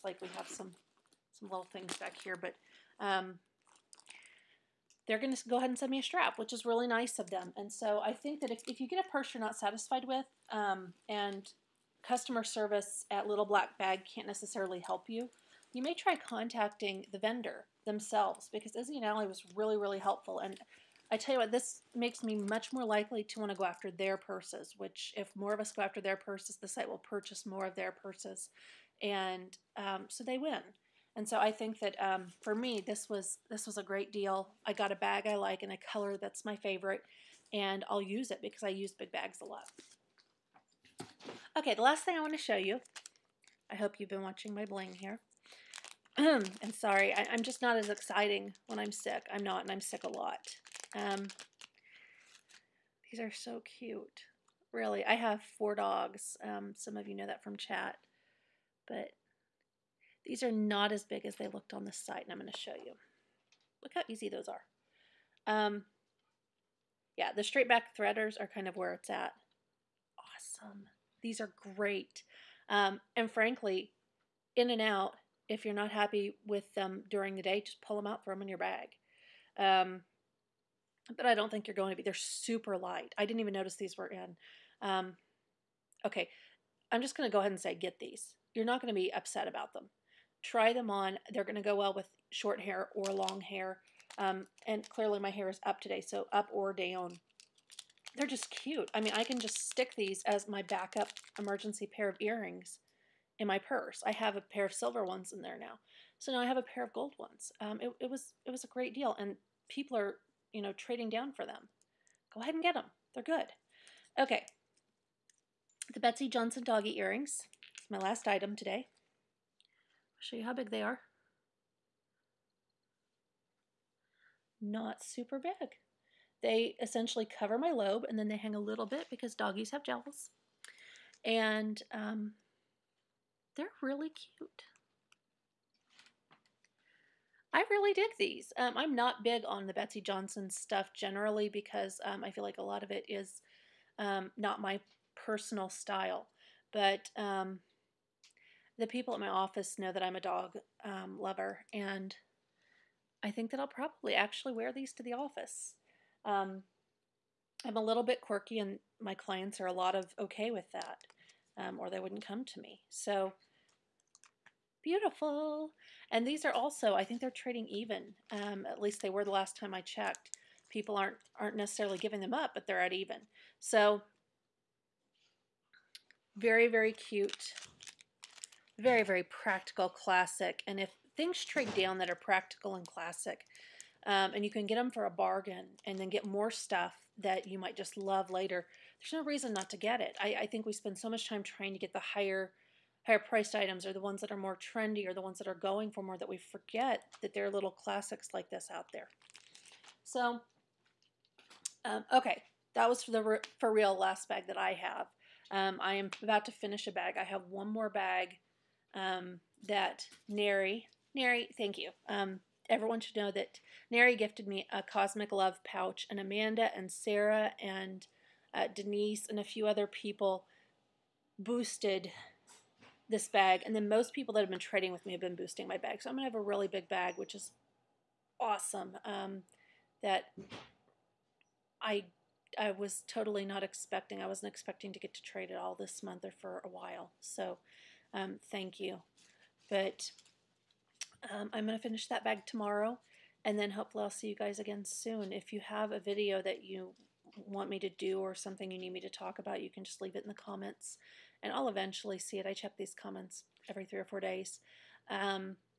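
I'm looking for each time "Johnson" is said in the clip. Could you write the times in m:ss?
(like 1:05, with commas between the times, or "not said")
1:56, 2:20.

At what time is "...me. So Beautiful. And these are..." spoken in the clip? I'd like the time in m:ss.
2:42.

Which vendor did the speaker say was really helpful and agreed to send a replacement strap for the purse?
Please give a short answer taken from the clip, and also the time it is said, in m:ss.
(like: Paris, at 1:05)
Izzy and Ali, at 0:18.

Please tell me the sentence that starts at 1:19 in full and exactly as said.
Um, but I don't think you're going to be.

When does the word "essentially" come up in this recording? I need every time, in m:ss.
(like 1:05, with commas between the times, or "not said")
2:06.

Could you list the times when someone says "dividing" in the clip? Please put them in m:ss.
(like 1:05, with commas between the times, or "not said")
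not said.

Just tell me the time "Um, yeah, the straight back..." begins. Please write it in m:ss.
1:05.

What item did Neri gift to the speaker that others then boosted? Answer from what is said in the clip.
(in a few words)
Cosmic Love pouch.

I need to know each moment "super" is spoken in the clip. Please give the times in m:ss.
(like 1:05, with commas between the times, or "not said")
1:22, 2:05.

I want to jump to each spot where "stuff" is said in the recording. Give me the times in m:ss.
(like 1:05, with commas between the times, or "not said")
2:20, 3:06.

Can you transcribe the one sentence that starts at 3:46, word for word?
So I'm going to have a really big bag, which is awesome.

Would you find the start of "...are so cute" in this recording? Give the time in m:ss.
0:53.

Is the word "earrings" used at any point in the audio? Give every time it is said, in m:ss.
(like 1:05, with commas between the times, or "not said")
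1:42, 1:56.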